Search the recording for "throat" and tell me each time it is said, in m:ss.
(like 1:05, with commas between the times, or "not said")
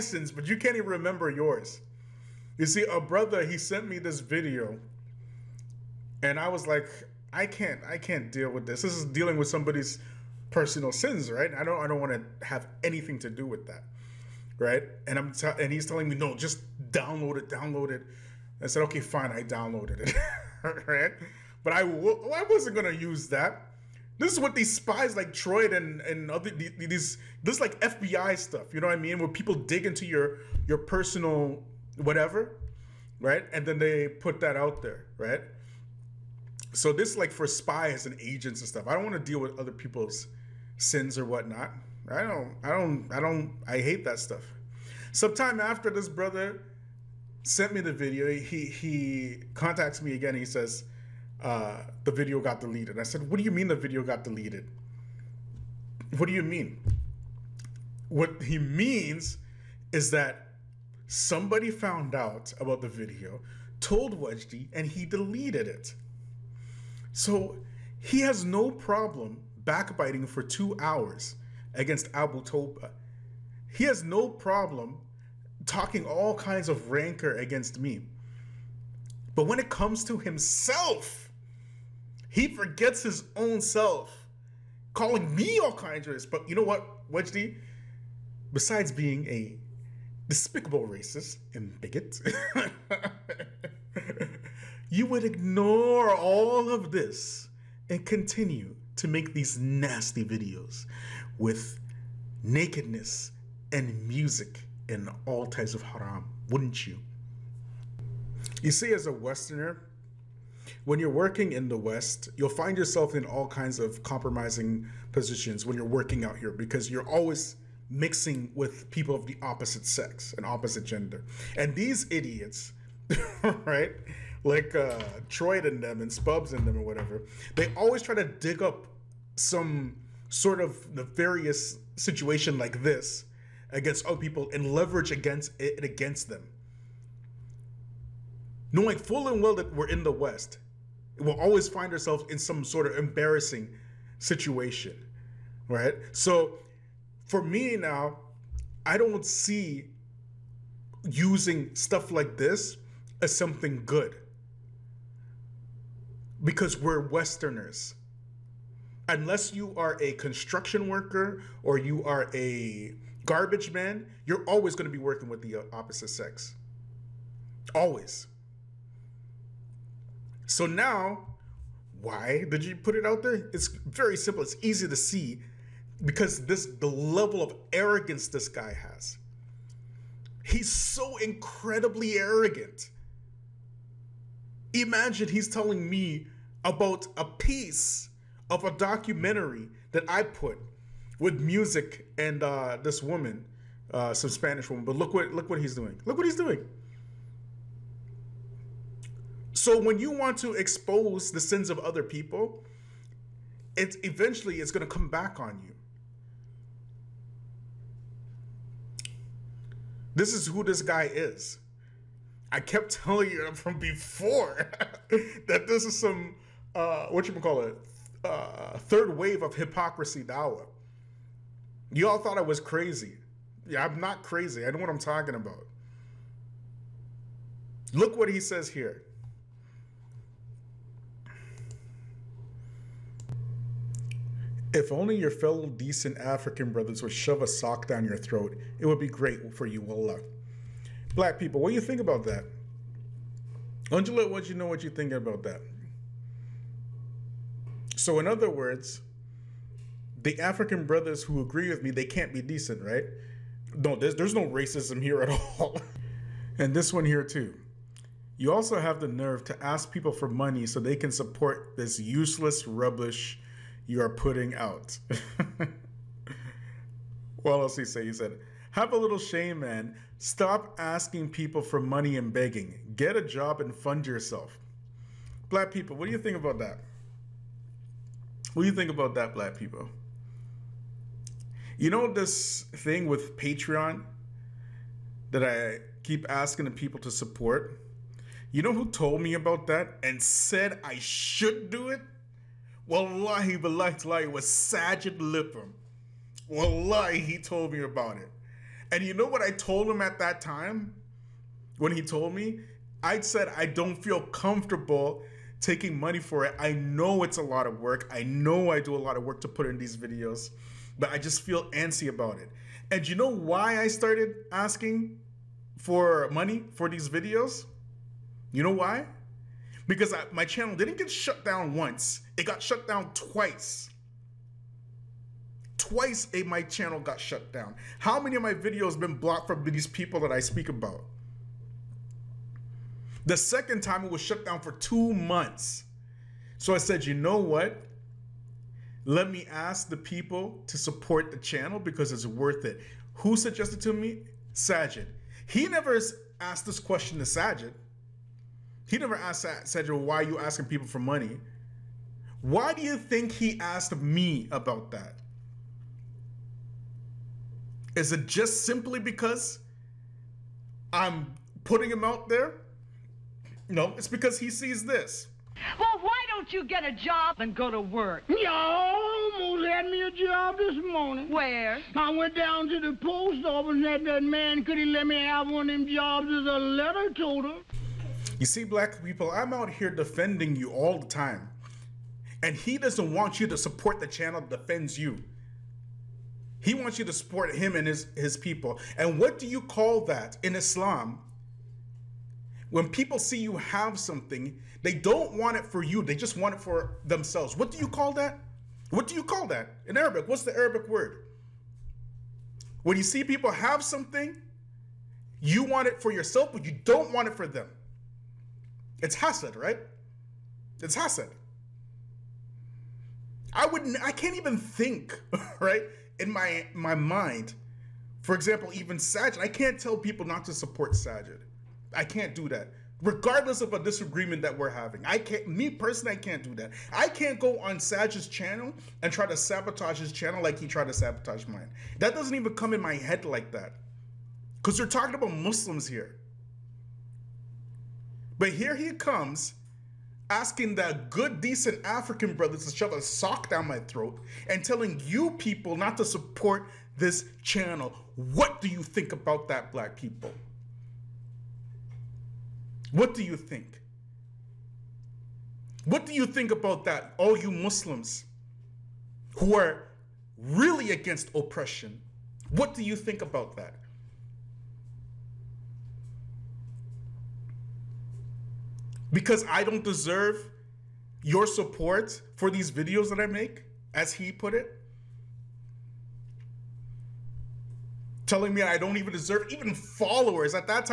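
3:58, 7:23.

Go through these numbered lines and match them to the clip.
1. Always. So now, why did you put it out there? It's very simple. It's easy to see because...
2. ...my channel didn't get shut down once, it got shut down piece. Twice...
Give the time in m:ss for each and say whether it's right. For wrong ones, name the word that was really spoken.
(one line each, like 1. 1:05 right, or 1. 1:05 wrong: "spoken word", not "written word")
1. 2:47 right
2. 5:20 wrong: "twice", not "piece".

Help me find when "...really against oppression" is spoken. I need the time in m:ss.
7:40.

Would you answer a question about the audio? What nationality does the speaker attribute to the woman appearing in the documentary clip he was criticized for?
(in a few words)
Spanish.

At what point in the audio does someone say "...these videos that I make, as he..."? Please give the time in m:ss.
7:52.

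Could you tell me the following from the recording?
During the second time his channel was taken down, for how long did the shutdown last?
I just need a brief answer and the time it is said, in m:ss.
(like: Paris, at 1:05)
2 months, at 5:34.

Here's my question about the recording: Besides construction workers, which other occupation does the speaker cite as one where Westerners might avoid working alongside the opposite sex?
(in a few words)
garbage man.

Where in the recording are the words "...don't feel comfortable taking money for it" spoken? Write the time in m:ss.
5:03.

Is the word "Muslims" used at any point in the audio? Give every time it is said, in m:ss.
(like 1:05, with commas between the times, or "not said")
7:15, 7:37.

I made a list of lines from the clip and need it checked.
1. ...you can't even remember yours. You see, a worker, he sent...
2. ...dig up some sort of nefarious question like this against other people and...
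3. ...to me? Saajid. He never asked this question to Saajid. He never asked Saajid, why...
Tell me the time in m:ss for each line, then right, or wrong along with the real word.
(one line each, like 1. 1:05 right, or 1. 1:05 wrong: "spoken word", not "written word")
1. 0:00 wrong: "brother", not "worker"
2. 2:08 wrong: "situation", not "question"
3. 5:43 right.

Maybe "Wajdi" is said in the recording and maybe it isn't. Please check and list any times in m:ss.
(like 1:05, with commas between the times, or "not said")
1:04, 1:27.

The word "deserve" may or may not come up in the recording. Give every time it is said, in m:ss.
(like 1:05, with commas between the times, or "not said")
7:49, 7:59.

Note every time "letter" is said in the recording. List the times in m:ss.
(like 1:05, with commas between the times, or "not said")
6:16.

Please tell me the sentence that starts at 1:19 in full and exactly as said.
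But when it comes to himself, he forgets his own self, calling me all kinds of racists.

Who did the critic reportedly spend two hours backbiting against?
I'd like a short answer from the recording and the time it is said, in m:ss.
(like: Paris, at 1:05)
Abu Toba, at 1:12.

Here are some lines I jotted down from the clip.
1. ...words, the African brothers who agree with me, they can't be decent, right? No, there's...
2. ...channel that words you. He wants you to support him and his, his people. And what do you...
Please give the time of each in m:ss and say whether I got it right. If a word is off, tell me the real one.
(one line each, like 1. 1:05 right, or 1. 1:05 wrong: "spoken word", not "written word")
1. 4:08 right
2. 6:24 wrong: "defends", not "words".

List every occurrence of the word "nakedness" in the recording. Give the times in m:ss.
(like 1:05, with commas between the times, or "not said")
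1:42.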